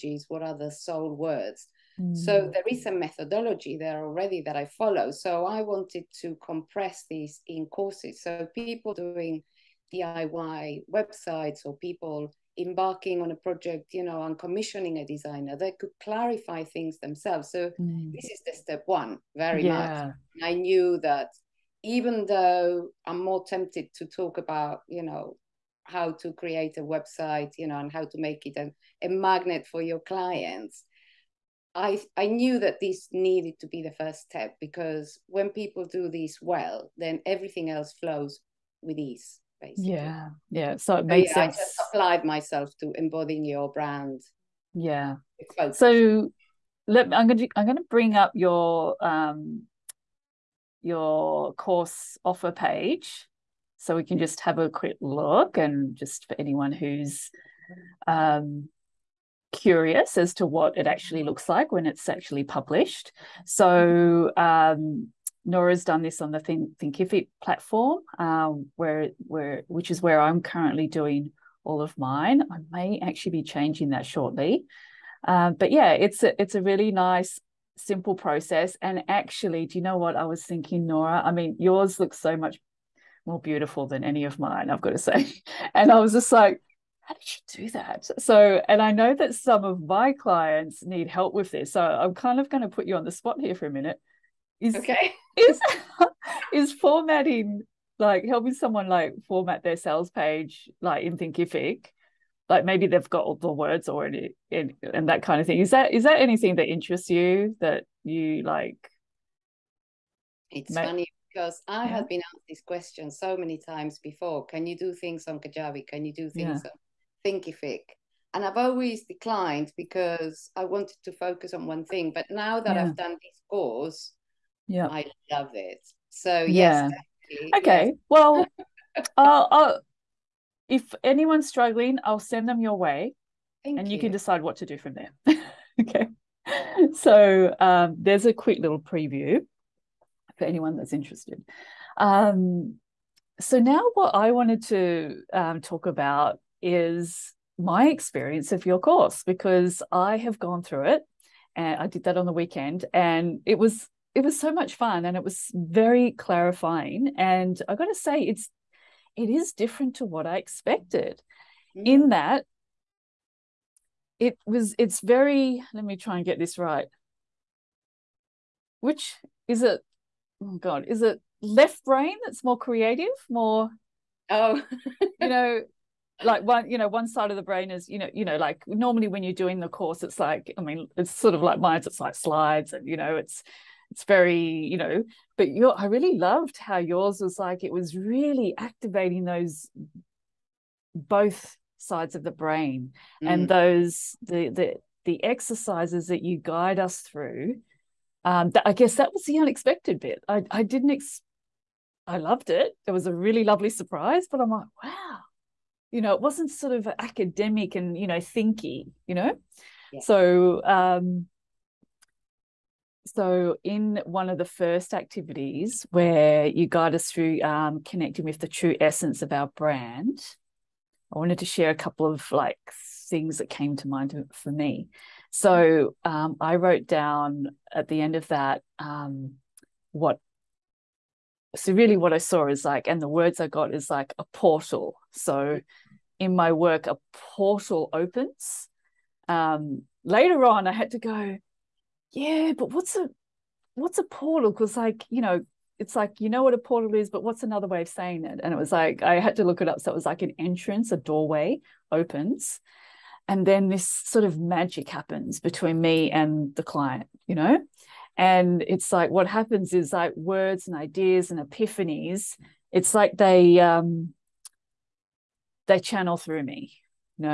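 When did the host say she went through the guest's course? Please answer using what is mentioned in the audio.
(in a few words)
On the weekend.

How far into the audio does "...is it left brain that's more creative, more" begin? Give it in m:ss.
2:50.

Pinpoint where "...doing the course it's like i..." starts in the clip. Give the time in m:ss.
2:59.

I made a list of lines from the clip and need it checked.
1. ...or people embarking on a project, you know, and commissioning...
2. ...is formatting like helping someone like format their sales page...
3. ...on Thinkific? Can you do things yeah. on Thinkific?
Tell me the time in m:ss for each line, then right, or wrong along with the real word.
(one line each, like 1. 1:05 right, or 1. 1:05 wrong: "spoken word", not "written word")
1. 0:11 right
2. 1:36 right
3. 1:55 wrong: "Kajabi", not "Thinkific".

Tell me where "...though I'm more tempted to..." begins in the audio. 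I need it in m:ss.
0:22.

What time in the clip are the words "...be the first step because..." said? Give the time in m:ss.
0:33.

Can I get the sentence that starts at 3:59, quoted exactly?
Um, later on, I had to go yeah, but what's a what's a portal?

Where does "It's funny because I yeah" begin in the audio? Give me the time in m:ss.
1:50.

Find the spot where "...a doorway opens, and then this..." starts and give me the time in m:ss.
4:10.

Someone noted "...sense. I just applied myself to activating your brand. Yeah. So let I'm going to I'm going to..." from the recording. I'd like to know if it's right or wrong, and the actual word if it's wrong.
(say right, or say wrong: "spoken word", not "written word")
wrong: "embodying", not "activating".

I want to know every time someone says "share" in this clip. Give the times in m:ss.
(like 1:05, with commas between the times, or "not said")
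3:41.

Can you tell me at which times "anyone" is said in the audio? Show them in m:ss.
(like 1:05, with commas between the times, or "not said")
0:56, 2:11, 2:20.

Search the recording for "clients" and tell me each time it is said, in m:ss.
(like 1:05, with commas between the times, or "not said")
0:29, 1:30, 4:16.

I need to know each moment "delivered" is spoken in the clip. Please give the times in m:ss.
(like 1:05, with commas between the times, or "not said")
not said.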